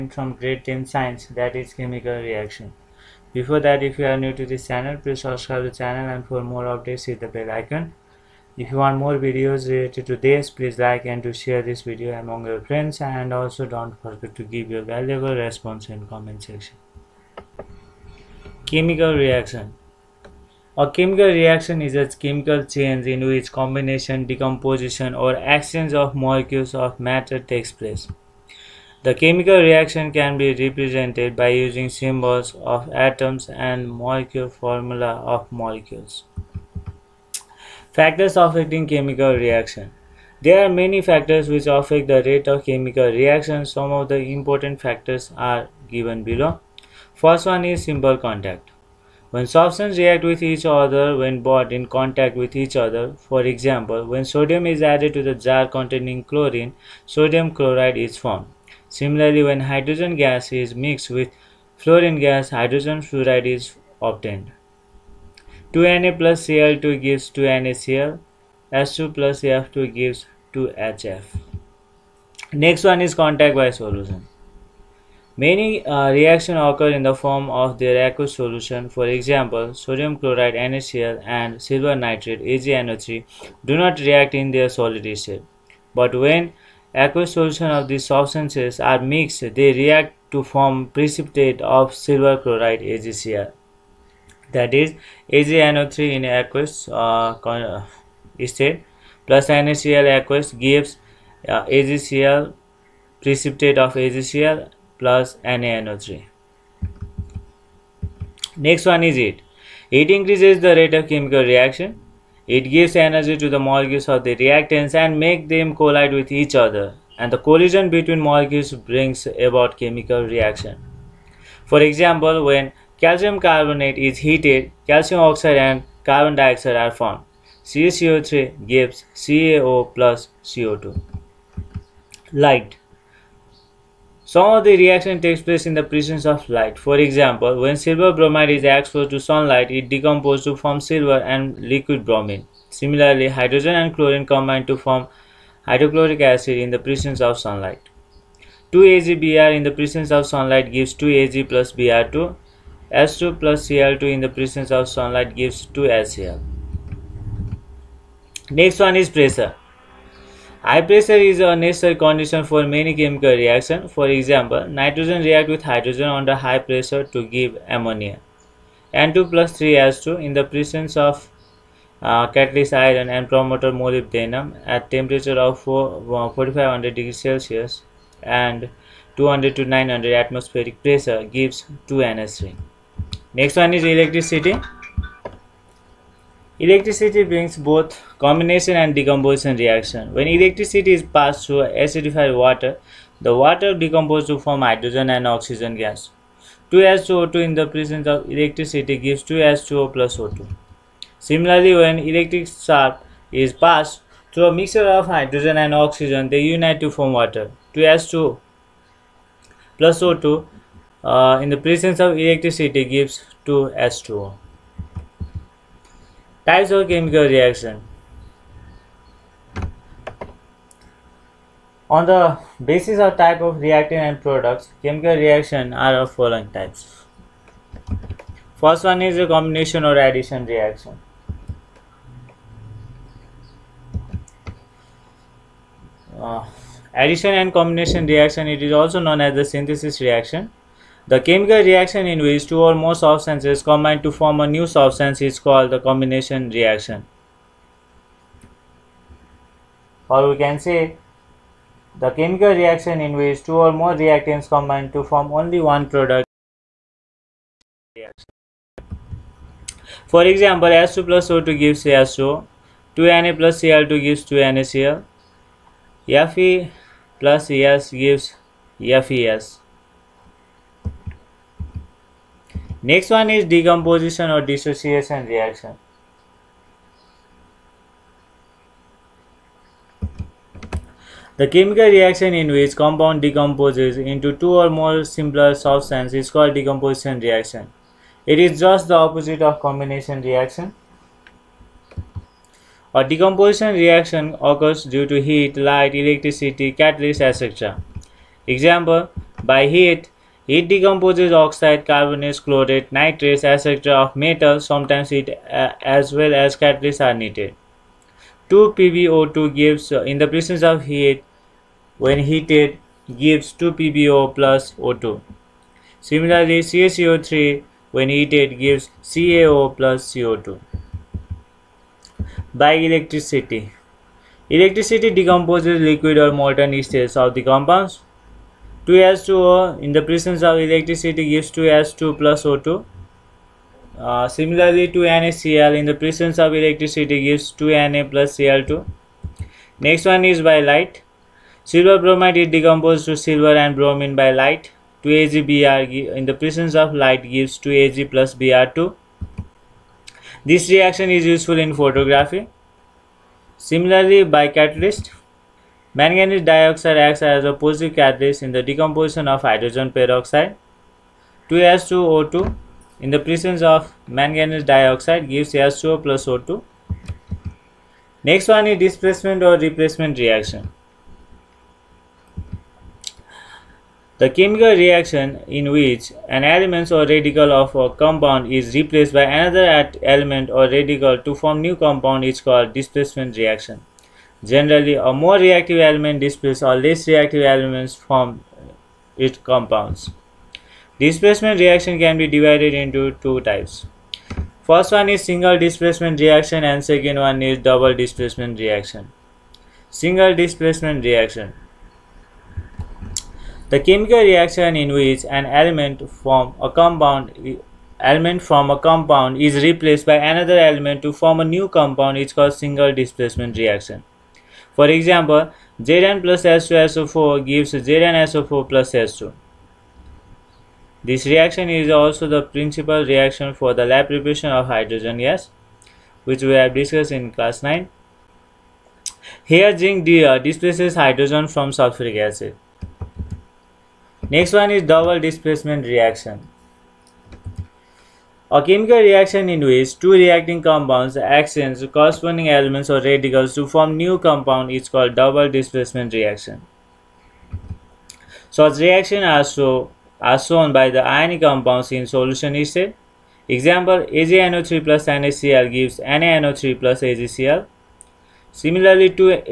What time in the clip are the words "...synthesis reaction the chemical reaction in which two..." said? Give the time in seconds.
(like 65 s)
239 s.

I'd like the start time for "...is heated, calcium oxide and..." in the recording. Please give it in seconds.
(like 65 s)
123 s.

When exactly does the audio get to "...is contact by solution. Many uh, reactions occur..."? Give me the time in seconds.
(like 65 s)
72 s.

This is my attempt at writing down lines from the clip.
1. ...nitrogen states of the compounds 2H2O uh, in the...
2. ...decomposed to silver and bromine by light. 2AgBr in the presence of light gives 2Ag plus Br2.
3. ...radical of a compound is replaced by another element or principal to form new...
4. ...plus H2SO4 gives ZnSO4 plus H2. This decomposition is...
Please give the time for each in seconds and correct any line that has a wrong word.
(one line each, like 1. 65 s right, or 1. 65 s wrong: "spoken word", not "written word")
1. 326 s wrong: "molten", not "nitrogen"
2. 342 s right
3. 377 s wrong: "radical", not "principal"
4. 416 s wrong: "reaction", not "decomposition".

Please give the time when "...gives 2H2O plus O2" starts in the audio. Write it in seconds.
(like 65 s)
198 s.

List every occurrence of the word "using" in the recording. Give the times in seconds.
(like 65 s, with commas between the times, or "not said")
31 s.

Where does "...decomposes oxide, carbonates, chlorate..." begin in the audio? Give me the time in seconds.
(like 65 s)
300 s.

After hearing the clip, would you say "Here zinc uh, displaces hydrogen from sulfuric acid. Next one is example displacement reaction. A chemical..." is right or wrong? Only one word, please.
wrong.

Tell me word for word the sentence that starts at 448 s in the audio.
Such reaction are, so, are shown by the ionic compounds in solution state.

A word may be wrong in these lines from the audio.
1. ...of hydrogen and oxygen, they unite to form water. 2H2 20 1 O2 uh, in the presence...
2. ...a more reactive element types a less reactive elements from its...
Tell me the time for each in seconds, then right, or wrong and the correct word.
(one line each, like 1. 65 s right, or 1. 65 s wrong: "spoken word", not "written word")
1. 204 s wrong: "0", not "1"
2. 384 s wrong: "displaces", not "types".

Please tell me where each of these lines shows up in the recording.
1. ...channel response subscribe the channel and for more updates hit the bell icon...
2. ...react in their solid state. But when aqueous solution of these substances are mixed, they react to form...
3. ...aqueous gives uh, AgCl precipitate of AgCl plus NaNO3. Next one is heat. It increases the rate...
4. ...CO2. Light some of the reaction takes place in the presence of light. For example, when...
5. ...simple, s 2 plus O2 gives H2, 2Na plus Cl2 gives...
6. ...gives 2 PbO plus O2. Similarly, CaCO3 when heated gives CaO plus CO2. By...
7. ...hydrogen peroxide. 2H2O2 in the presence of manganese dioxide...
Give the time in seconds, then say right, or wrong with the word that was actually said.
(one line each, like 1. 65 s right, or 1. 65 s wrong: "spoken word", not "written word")
1. 4 s wrong: "please", not "response"
2. 84 s right
3. 100 s right
4. 130 s right
5. 260 s wrong: "example", not "simple"
6. 313 s right
7. 359 s right.